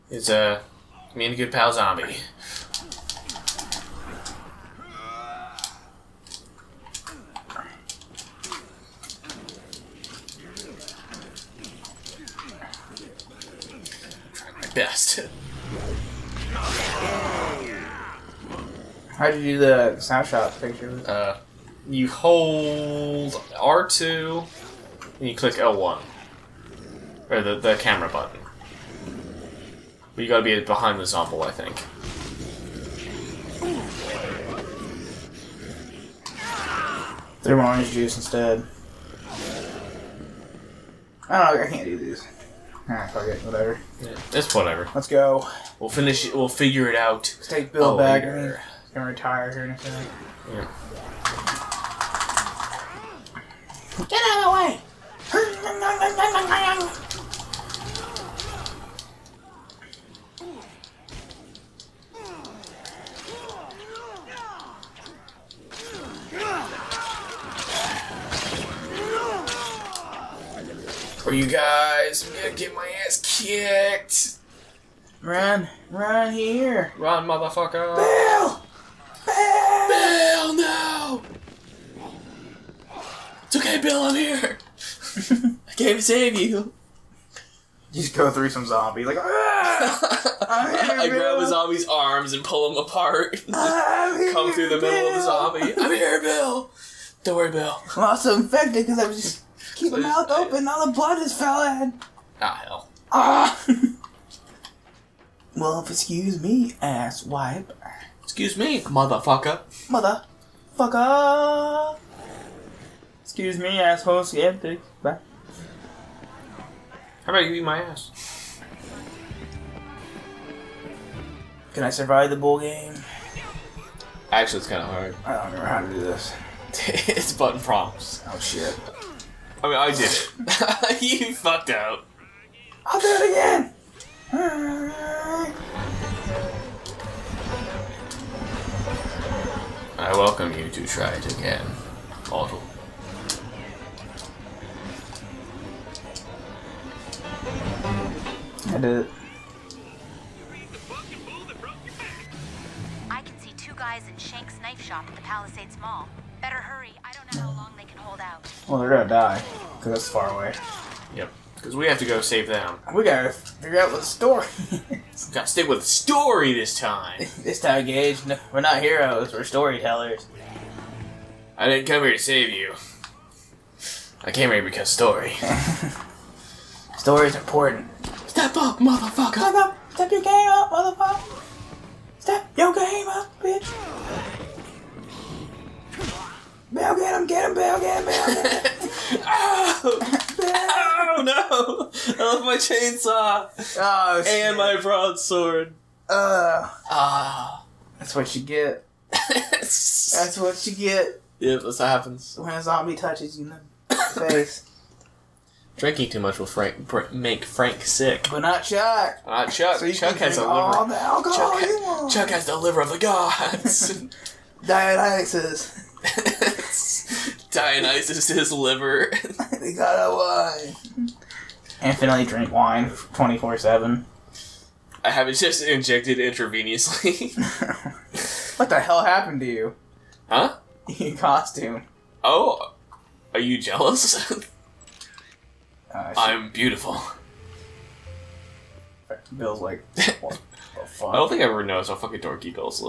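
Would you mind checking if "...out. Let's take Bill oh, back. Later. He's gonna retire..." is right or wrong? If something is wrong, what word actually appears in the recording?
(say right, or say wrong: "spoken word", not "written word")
right.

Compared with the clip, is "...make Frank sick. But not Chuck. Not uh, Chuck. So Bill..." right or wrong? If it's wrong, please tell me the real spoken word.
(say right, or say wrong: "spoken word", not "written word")
wrong: "Chuck", not "Bill".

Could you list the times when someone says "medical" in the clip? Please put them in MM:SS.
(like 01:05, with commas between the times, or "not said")
not said.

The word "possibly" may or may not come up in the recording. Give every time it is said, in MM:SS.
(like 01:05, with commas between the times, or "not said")
not said.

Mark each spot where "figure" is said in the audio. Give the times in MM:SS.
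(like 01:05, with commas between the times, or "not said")
00:46, 02:43.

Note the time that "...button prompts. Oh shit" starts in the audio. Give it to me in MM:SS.
02:07.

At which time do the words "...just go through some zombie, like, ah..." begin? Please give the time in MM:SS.
01:28.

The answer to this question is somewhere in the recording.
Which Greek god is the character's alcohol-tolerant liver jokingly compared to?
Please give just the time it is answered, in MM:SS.
03:37.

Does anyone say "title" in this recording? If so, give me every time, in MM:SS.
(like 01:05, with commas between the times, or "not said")
not said.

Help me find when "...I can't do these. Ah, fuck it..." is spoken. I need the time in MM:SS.
00:41.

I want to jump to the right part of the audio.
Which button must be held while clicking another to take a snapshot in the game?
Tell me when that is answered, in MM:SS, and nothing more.
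00:23.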